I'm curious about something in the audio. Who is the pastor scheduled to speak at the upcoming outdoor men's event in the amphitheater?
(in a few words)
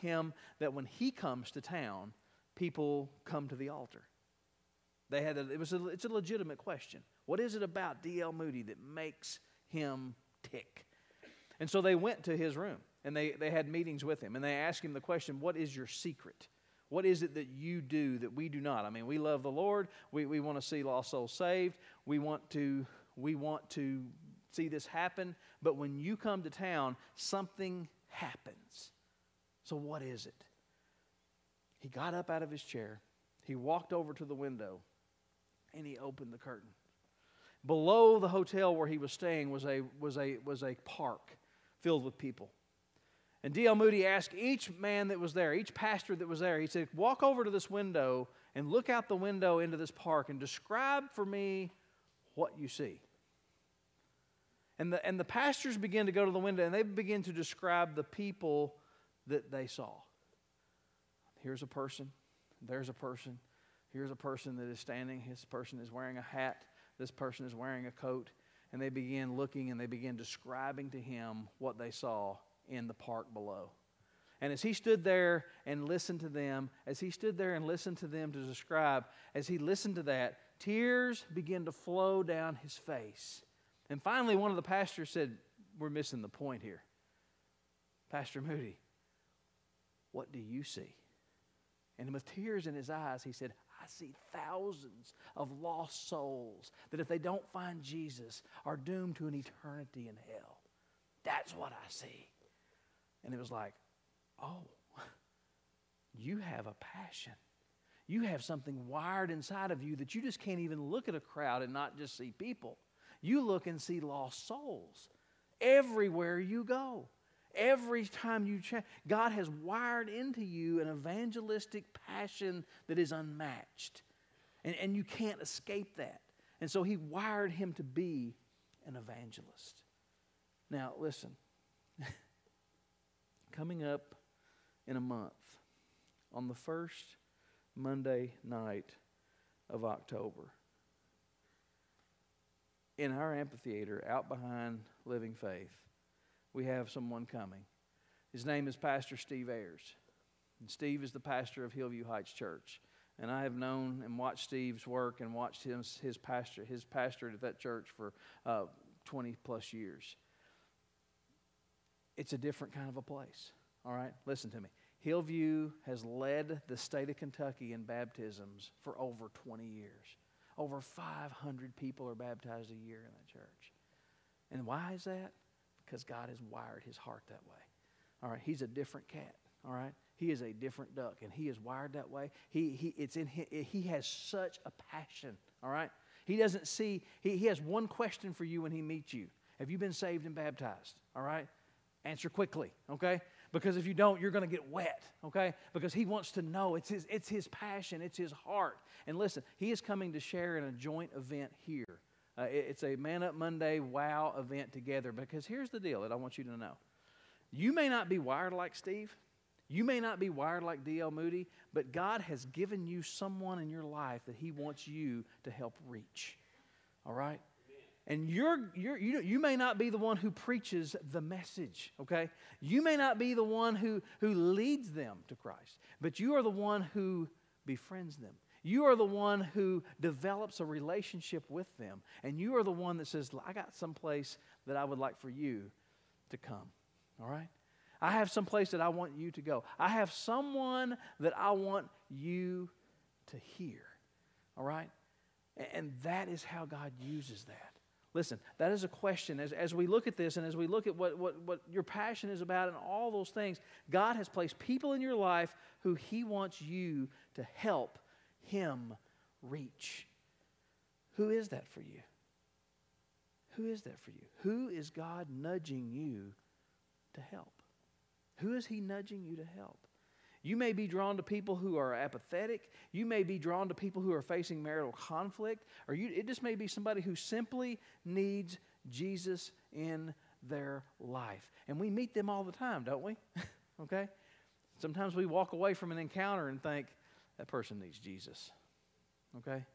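Steve Ayers.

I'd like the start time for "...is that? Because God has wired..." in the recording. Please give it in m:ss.
2:54.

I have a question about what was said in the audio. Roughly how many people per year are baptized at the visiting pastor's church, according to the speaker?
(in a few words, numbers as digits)
Over 500.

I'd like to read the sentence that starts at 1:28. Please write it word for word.
Pastor Moody, what do you see?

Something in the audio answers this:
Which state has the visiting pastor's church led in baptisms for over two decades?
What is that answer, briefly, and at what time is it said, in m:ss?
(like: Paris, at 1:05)
Kentucky, at 2:47.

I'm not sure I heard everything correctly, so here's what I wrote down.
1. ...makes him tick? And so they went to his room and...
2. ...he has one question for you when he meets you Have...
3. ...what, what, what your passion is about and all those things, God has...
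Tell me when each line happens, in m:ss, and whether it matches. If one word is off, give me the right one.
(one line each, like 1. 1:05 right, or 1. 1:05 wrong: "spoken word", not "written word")
1. 0:08 right
2. 3:07 right
3. 4:10 right.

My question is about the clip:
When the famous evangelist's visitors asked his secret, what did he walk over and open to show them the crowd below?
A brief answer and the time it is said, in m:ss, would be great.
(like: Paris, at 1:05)
The curtain, at 0:36.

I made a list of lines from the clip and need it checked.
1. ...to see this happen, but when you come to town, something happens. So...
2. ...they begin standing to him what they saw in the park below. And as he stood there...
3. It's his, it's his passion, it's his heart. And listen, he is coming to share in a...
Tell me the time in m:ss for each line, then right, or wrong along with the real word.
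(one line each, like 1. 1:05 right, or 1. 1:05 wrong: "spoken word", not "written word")
1. 0:23 right
2. 1:09 wrong: "describing", not "standing"
3. 3:16 right.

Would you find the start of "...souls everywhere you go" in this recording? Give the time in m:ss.
1:54.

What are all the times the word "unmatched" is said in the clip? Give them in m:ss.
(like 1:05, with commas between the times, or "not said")
2:03.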